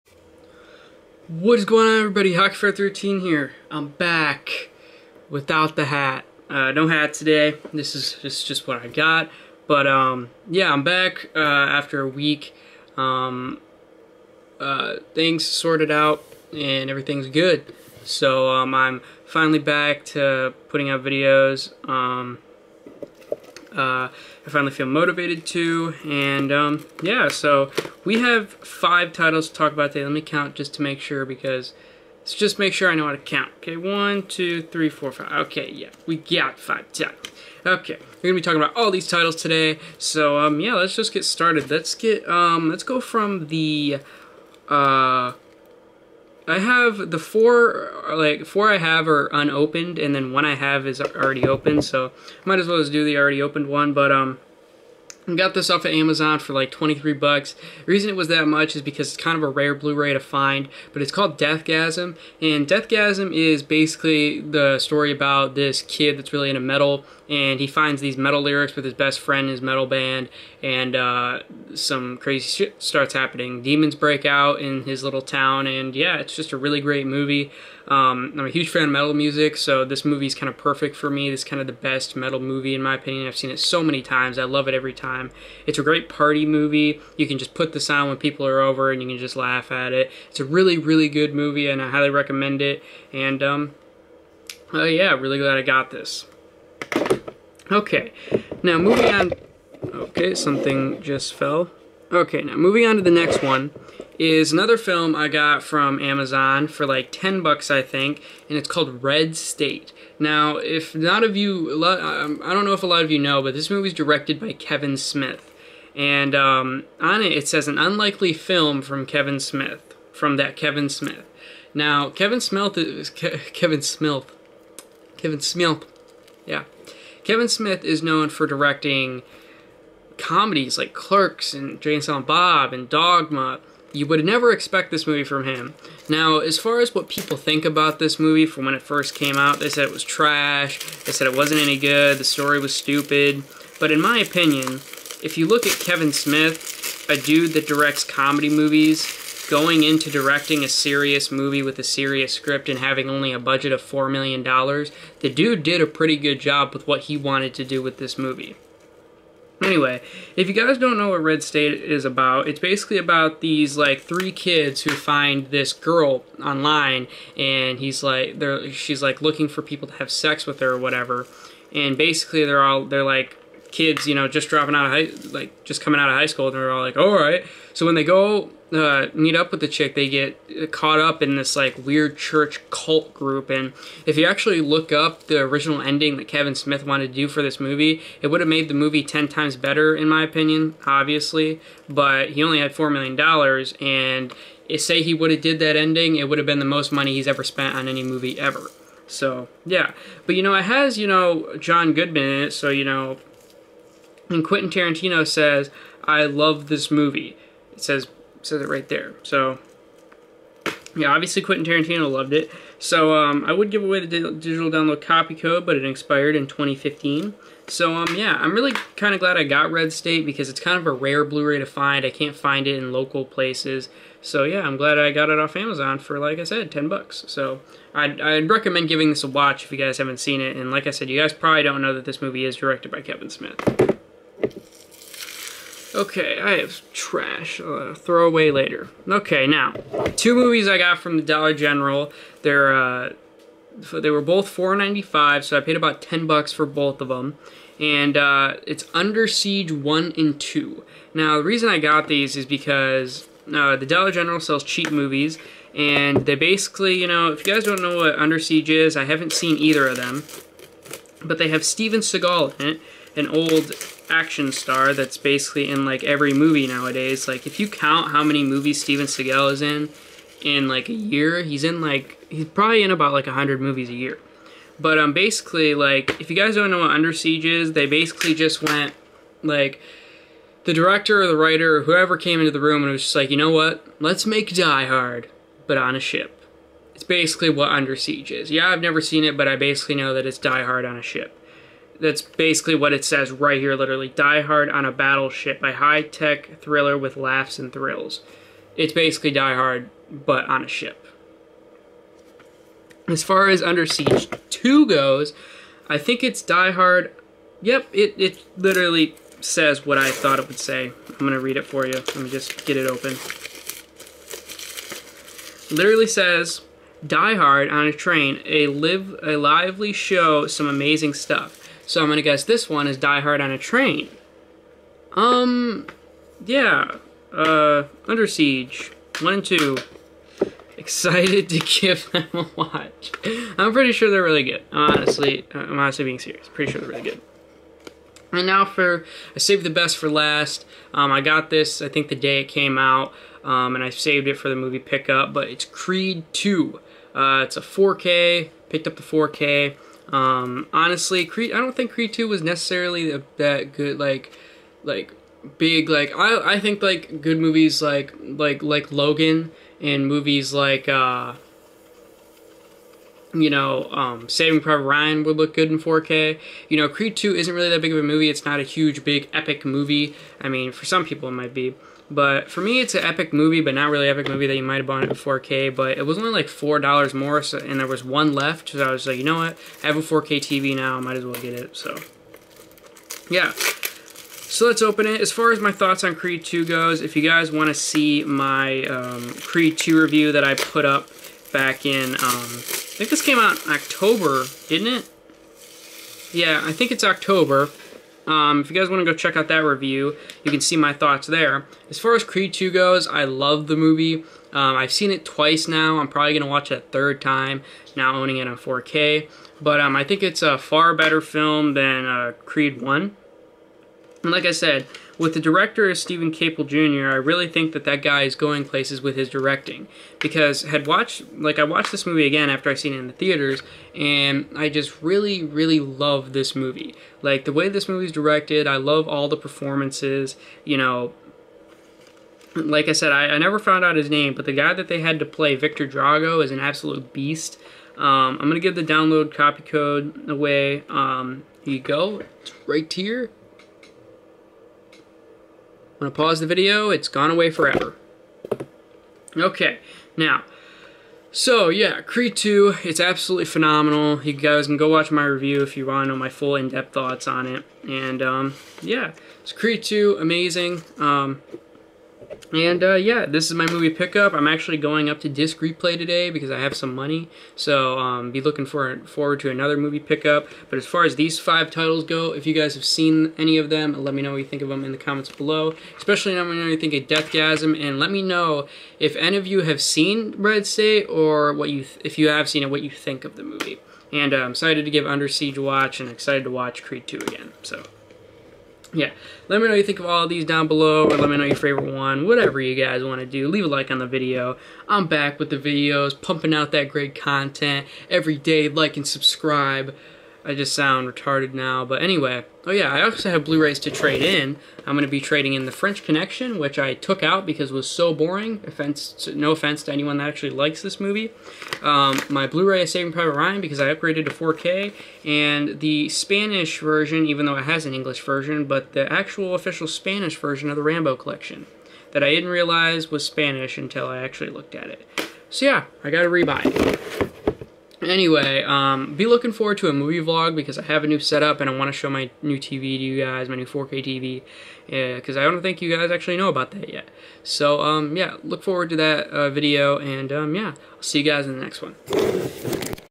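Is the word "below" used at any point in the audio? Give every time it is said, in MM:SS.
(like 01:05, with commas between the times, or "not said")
07:55, 08:10.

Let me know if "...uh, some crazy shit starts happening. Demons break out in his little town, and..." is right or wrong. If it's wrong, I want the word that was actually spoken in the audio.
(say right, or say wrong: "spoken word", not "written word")
right.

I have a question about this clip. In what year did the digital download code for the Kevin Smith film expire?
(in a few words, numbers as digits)
2015.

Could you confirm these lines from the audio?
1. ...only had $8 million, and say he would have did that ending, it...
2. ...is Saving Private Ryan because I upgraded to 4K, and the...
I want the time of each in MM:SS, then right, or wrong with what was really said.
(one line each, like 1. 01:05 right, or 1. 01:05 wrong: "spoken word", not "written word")
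1. 03:12 wrong: "4", not "8"
2. 08:32 right.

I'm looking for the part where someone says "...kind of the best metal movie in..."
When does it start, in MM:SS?
01:21.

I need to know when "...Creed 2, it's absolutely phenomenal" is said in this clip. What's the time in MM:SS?
07:32.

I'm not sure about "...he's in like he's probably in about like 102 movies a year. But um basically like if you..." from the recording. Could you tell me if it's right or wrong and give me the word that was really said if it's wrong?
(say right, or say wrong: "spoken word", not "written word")
wrong: "100", not "102".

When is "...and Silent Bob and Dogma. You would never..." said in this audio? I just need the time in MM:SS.
02:11.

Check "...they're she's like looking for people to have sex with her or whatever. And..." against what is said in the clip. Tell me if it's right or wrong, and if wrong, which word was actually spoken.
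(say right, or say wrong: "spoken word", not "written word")
right.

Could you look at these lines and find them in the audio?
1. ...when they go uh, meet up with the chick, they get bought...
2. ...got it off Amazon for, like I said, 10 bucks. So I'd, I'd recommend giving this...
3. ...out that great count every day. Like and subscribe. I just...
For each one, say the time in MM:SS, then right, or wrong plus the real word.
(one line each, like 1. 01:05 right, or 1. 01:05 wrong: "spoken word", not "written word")
1. 02:57 wrong: "caught", not "bought"
2. 03:45 right
3. 08:16 wrong: "content", not "count".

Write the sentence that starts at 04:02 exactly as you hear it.
They're, uh, they were both four ninety five, so I paid about 10 bucks for both of them.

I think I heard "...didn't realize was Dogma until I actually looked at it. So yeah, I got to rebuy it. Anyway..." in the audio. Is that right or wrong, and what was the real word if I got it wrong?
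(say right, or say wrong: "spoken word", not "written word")
wrong: "Spanish", not "Dogma".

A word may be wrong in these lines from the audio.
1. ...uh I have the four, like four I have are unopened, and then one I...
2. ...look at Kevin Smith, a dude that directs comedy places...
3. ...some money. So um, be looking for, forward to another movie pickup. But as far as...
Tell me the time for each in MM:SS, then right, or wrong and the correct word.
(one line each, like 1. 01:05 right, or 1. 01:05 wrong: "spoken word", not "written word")
1. 00:44 right
2. 02:25 wrong: "movies", not "places"
3. 07:46 right.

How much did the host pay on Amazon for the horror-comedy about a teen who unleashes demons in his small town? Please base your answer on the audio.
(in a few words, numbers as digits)
$23.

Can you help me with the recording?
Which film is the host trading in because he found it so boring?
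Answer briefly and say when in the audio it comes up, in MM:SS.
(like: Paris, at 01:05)
The French Connection, at 08:25.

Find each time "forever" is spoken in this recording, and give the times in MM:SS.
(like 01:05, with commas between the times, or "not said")
07:27.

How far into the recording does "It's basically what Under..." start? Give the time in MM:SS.
04:46.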